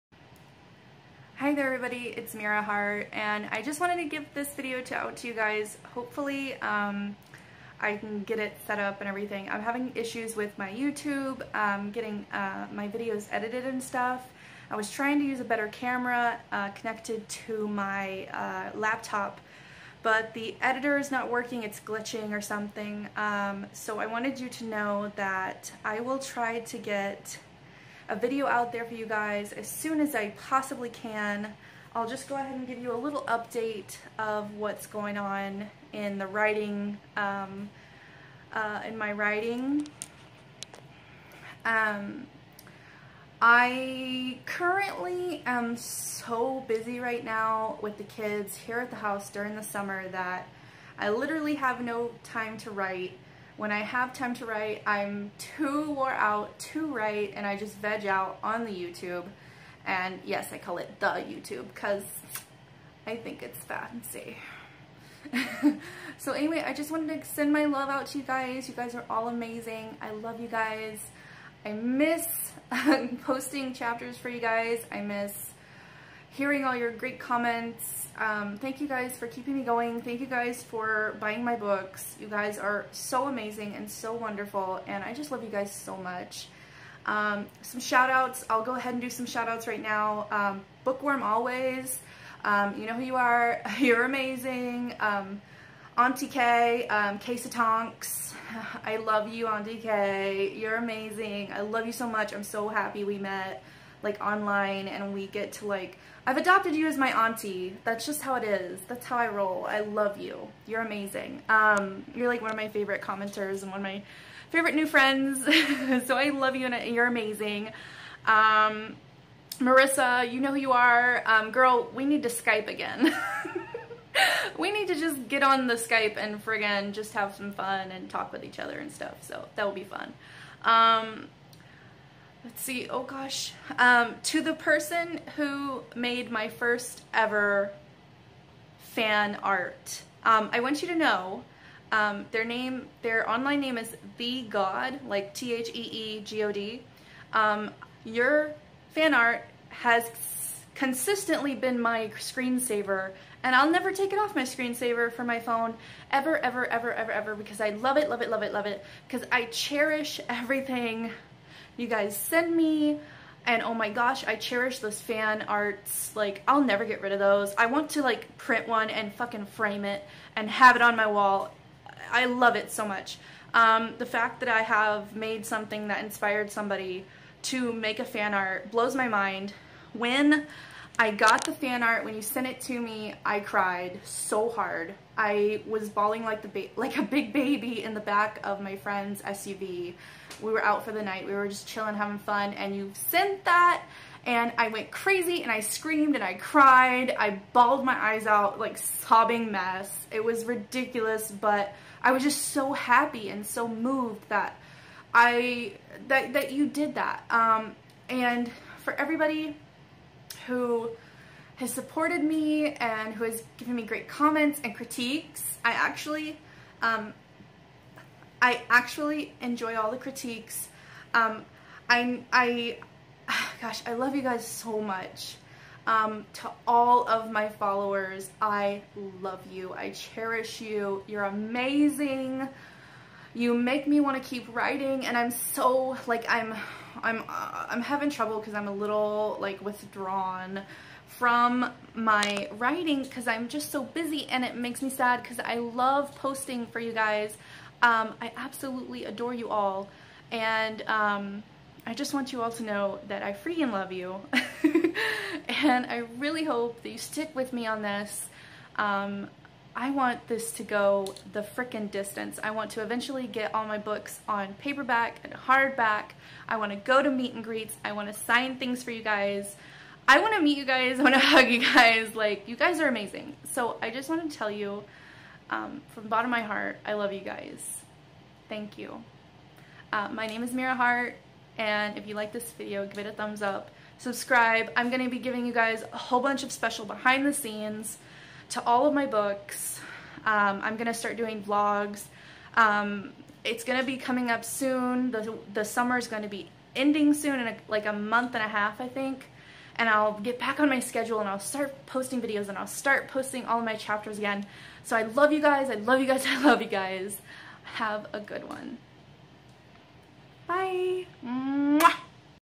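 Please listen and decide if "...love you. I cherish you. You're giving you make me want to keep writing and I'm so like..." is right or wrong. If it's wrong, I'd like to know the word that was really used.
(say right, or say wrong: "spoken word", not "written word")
wrong: "amazing", not "giving".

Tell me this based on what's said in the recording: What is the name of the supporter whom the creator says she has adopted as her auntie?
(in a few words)
Case of Tonks.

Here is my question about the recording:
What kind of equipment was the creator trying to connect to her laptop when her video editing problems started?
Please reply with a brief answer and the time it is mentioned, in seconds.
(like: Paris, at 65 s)
A better camera, at 15 s.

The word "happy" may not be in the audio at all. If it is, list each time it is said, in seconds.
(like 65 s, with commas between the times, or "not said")
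102 s, 202 s.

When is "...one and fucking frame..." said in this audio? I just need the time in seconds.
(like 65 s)
168 s.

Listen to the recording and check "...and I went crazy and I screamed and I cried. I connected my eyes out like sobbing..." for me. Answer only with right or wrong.
wrong.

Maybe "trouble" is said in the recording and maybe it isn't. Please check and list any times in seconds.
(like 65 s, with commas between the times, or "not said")
238 s.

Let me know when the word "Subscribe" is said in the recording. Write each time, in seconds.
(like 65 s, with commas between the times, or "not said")
283 s.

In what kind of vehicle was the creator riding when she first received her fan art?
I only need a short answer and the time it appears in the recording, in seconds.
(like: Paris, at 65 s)
SUV, at 189 s.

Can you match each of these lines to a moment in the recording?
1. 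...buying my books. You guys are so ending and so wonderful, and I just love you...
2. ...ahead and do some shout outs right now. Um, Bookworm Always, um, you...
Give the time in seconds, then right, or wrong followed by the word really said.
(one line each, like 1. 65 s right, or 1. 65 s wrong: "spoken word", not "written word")
1. 81 s wrong: "amazing", not "ending"
2. 88 s right.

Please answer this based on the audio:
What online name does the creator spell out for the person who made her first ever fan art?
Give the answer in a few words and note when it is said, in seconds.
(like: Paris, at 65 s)
TheeGod, at 145 s.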